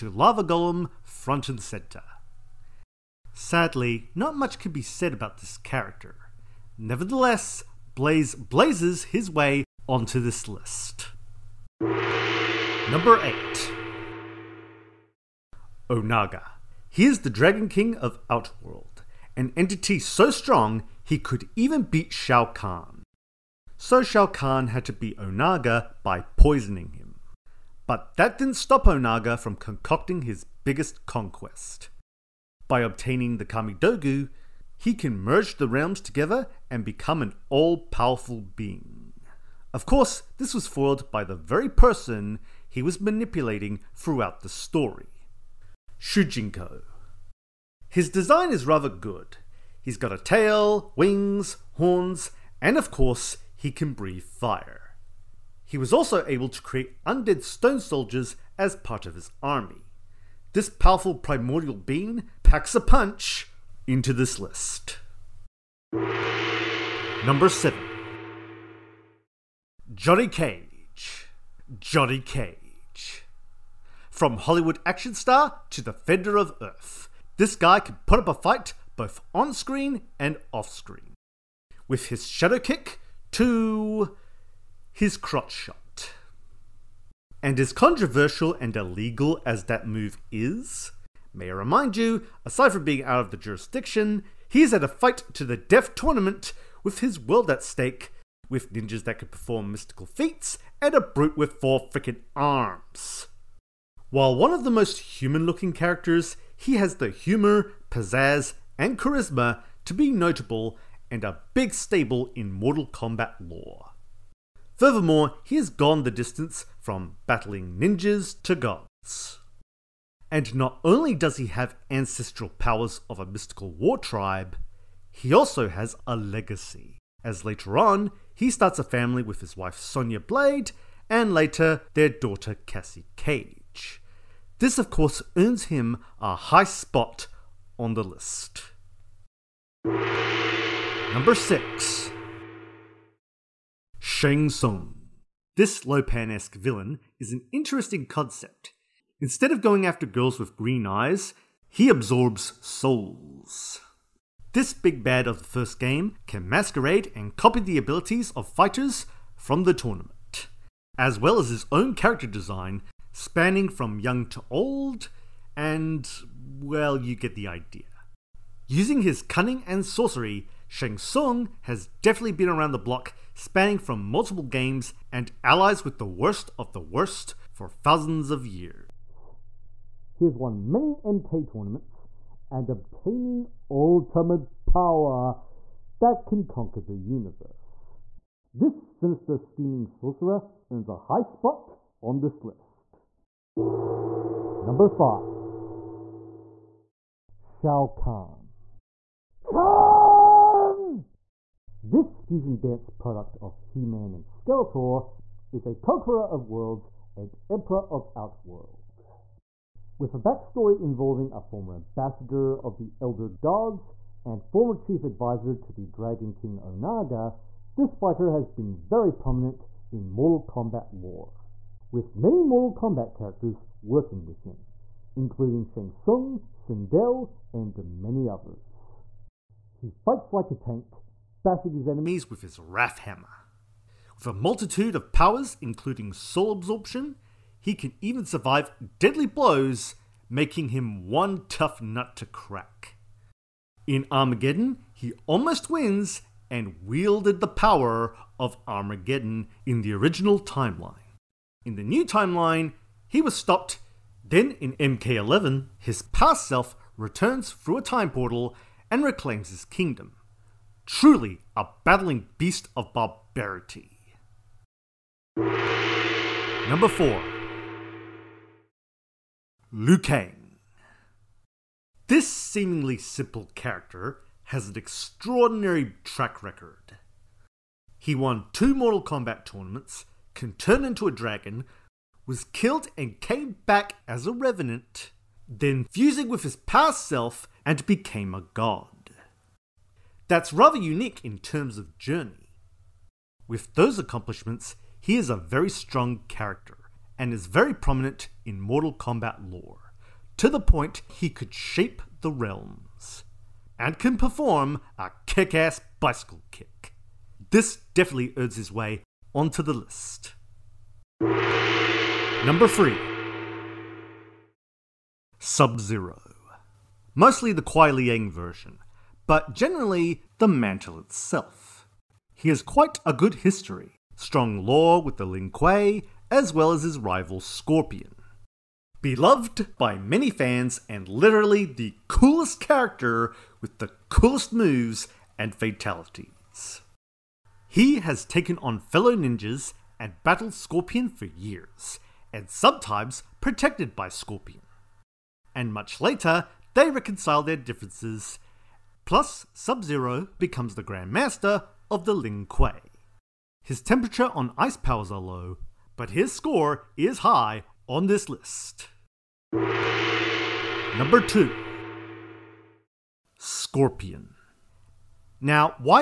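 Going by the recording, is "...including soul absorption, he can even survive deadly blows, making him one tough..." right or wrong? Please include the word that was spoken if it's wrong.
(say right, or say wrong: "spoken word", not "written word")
right.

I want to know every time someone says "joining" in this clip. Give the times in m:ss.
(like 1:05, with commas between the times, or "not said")
not said.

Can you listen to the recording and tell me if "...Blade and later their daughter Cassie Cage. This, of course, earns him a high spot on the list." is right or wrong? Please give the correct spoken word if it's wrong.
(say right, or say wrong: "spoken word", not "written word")
right.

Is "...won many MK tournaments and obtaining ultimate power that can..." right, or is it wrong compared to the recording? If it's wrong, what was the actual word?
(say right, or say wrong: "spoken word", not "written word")
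right.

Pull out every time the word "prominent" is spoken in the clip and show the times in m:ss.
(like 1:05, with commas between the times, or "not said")
3:39, 4:57.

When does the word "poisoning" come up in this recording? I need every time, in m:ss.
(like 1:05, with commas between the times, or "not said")
0:26.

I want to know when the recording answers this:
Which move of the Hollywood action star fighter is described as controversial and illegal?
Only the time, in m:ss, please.
1:25.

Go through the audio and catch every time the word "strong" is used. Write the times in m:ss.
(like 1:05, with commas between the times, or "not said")
0:20, 4:55, 5:24.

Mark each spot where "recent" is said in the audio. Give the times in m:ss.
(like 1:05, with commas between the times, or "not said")
not said.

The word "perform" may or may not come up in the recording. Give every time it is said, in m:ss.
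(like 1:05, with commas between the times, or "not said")
1:39, 5:04.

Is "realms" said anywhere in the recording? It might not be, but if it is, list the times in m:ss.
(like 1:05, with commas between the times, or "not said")
0:35, 5:02.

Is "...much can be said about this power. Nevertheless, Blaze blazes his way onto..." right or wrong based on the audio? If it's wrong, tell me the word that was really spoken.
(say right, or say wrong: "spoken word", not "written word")
wrong: "character", not "power".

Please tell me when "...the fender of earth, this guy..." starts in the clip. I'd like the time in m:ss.
1:15.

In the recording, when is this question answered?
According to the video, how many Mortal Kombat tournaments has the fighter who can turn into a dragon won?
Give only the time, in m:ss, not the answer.
4:38.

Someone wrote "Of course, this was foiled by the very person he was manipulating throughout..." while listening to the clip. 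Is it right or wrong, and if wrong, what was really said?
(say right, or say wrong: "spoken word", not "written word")
right.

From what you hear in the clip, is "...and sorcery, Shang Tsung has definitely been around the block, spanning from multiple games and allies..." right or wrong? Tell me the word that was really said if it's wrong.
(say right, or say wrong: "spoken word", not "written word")
right.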